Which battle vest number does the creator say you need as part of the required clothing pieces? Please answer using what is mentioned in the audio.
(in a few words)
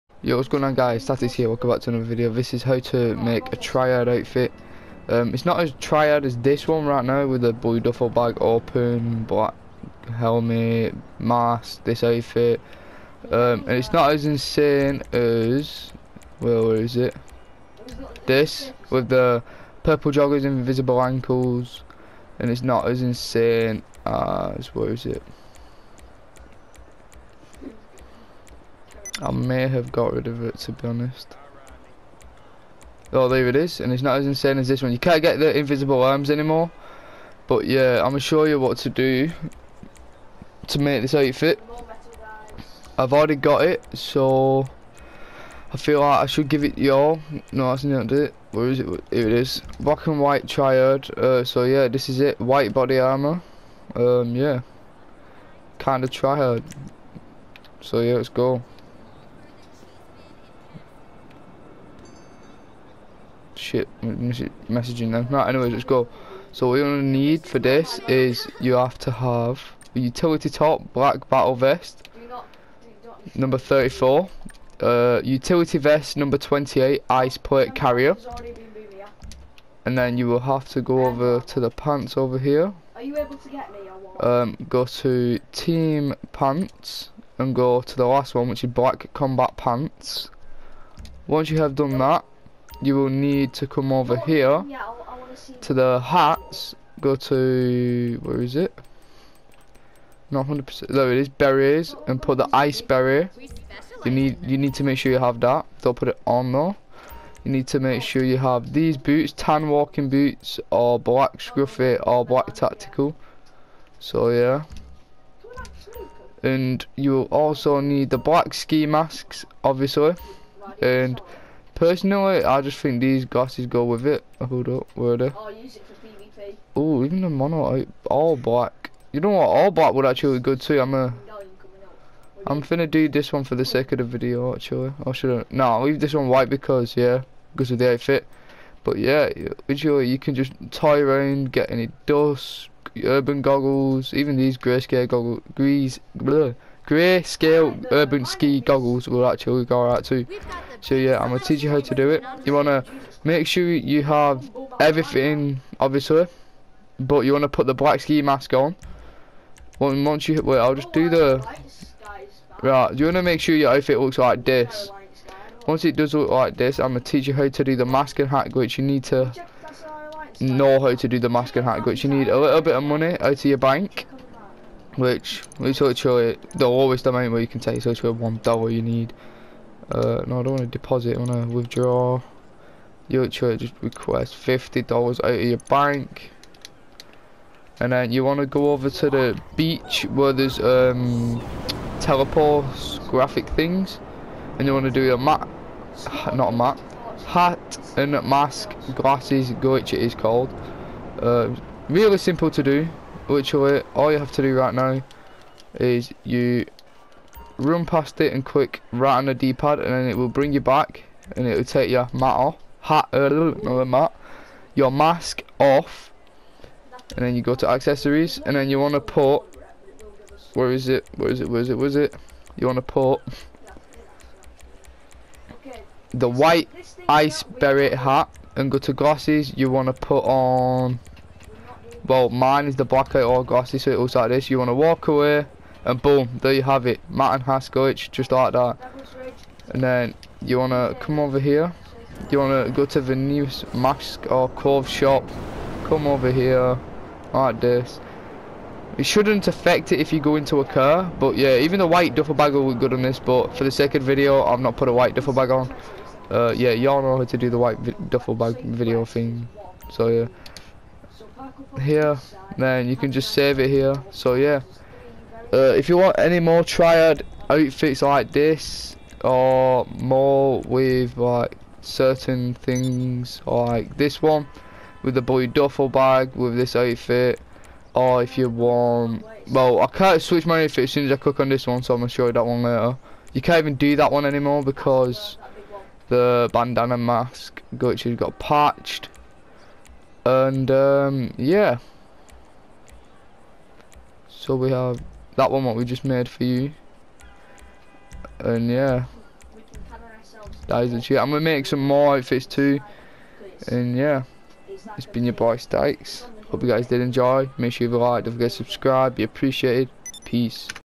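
34.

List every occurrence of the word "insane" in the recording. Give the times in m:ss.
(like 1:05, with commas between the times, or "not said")
0:14, 0:23, 0:34.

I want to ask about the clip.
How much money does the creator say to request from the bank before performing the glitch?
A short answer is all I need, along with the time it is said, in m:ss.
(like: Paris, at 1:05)
$50, at 3:04.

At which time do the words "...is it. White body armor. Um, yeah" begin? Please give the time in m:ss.
0:52.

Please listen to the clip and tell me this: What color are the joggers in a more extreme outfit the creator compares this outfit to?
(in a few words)
purple.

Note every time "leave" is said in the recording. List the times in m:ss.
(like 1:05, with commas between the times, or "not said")
2:15.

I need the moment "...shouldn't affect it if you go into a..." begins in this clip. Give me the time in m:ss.
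4:09.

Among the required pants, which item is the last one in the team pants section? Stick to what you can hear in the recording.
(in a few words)
black combat pants.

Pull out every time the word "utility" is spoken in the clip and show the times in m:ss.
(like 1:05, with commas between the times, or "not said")
1:09, 1:15.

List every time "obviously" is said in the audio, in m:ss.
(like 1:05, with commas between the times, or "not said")
1:59, 2:35.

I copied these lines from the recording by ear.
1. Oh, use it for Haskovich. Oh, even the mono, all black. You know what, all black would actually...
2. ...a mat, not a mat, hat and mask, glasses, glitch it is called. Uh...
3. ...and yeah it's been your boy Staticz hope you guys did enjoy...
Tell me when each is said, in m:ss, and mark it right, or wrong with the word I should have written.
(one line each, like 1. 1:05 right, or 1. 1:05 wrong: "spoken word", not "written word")
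1. 2:05 wrong: "PvP", not "Haskovich"
2. 3:15 right
3. 5:03 right.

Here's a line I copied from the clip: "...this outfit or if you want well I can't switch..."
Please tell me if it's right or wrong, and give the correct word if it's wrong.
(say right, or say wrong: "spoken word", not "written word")
right.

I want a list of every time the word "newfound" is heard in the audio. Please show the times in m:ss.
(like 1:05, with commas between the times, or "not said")
not said.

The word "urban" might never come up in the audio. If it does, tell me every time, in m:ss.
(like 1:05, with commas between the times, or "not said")
2:23, 2:27.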